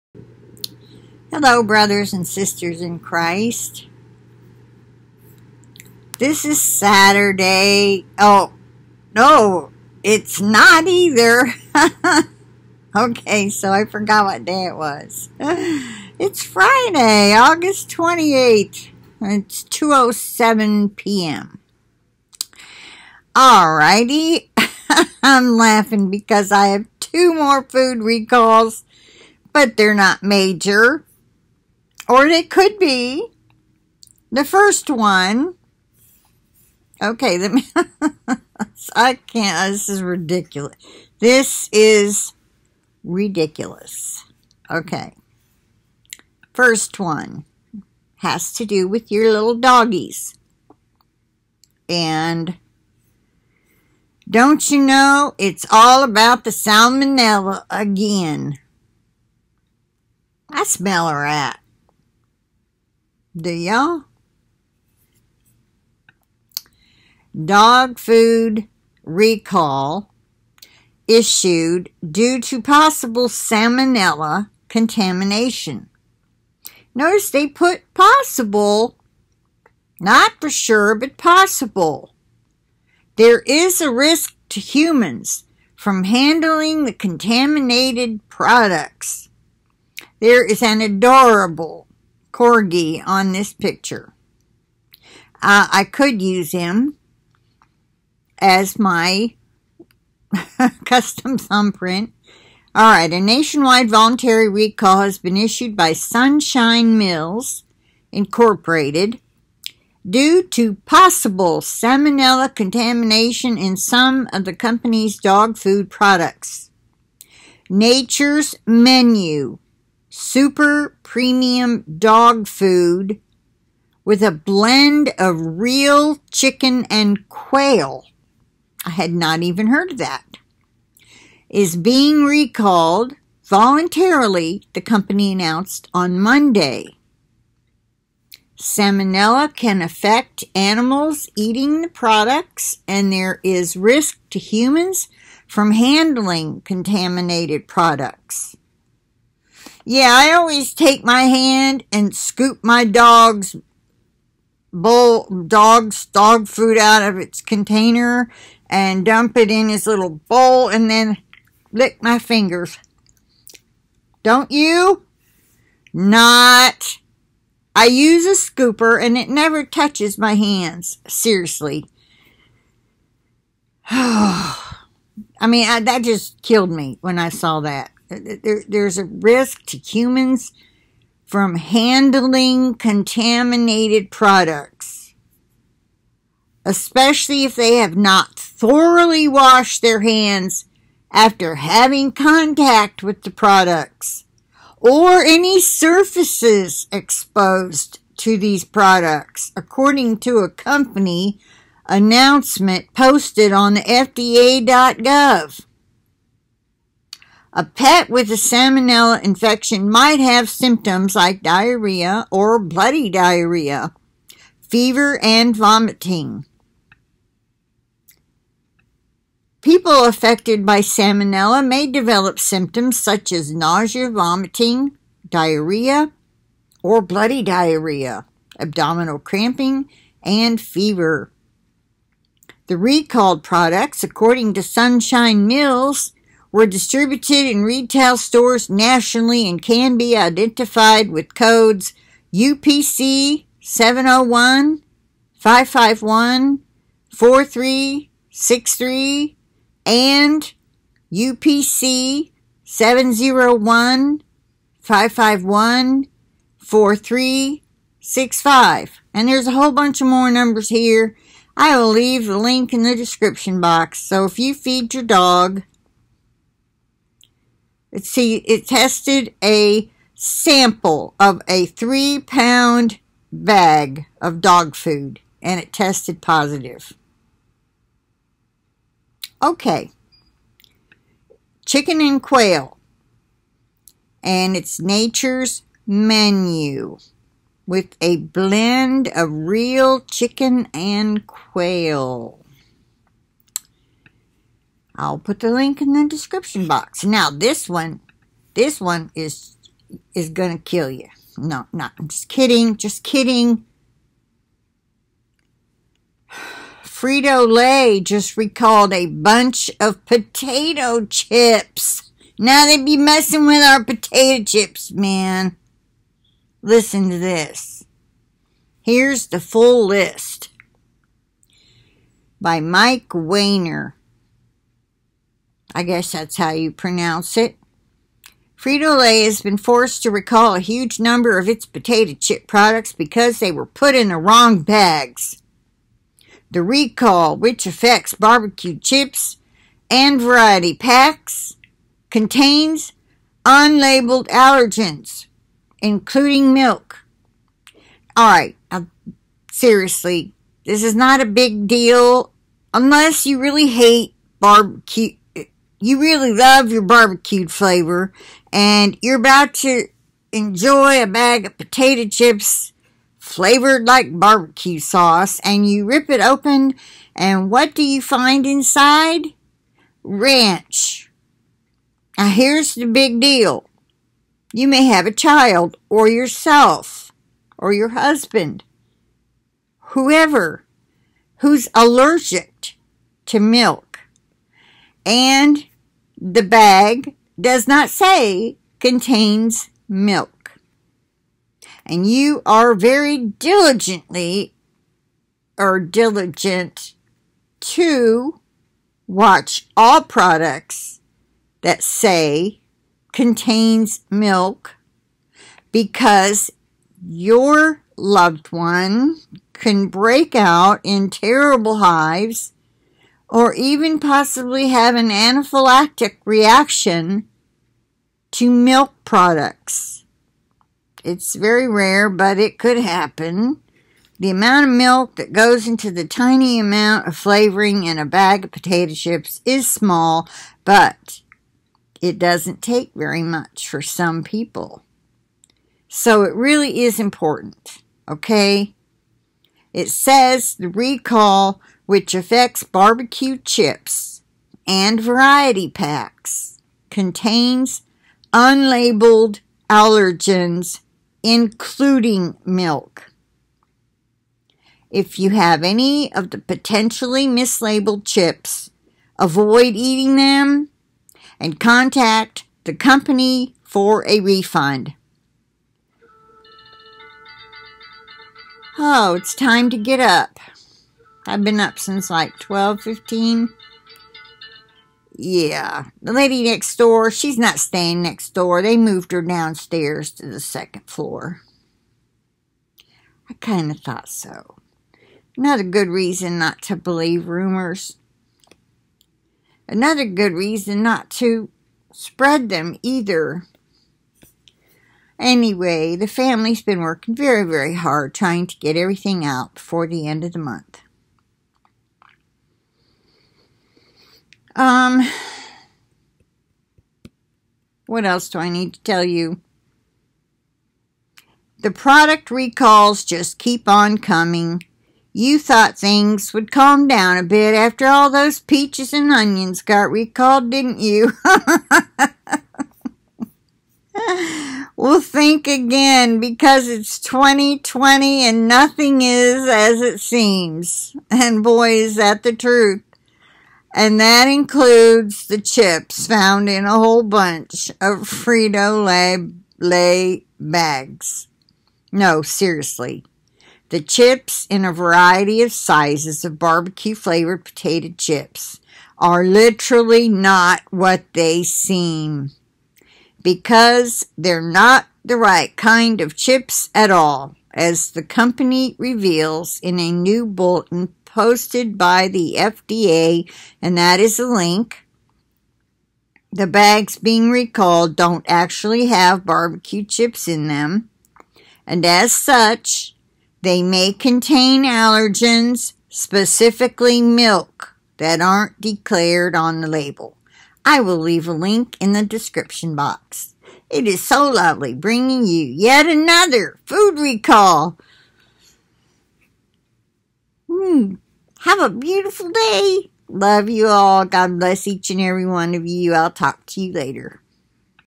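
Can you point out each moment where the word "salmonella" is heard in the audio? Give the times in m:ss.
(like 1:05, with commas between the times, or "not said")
0:56, 1:13, 1:51, 2:18, 3:28, 3:40.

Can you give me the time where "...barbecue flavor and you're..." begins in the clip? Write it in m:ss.
5:56.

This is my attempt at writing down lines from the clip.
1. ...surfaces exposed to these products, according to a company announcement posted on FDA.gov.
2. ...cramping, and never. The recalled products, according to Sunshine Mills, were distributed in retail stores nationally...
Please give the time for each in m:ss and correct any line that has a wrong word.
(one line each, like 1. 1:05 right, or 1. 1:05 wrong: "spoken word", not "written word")
1. 3:15 right
2. 3:49 wrong: "fever", not "never".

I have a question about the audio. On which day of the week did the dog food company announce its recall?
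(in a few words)
Monday.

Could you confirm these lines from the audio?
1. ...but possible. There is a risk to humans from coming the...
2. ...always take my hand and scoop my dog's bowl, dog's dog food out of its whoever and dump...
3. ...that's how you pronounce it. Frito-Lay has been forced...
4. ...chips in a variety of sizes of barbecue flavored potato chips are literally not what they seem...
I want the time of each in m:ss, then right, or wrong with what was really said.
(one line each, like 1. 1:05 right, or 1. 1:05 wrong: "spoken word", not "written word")
1. 1:20 wrong: "handling", not "coming"
2. 2:30 wrong: "container", not "whoever"
3. 5:26 right
4. 9:03 right.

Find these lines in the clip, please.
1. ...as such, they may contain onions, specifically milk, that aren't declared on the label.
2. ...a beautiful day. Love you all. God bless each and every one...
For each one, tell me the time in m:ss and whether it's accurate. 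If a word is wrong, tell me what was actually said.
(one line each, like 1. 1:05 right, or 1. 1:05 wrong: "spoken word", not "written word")
1. 9:31 wrong: "allergens", not "onions"
2. 9:51 right.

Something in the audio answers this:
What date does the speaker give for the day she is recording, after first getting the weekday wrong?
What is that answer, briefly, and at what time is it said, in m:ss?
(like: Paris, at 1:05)
August 28th, at 0:17.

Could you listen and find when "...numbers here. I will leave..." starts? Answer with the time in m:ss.
4:20.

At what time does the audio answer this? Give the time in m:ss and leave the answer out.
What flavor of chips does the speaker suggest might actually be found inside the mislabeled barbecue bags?
6:10.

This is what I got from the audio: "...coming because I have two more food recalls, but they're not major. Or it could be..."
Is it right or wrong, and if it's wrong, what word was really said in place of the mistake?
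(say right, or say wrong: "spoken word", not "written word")
wrong: "laughing", not "coming".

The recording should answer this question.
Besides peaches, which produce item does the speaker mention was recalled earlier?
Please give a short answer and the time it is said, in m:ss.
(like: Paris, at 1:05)
onions, at 8:39.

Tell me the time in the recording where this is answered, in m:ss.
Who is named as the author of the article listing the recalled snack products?
5:22.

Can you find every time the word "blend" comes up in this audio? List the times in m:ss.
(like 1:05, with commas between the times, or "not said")
2:04, 4:48.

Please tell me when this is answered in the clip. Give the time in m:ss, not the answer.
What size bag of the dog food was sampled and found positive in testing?
4:31.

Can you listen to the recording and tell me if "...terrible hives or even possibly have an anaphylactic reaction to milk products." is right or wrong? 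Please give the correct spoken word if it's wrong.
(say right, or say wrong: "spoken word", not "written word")
right.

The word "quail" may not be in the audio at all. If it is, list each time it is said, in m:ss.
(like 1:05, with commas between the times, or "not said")
2:07, 4:42, 4:51.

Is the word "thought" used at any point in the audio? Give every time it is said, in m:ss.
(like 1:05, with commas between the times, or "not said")
8:03, 8:35.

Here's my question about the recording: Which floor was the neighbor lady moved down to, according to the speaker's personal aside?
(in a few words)
second floor.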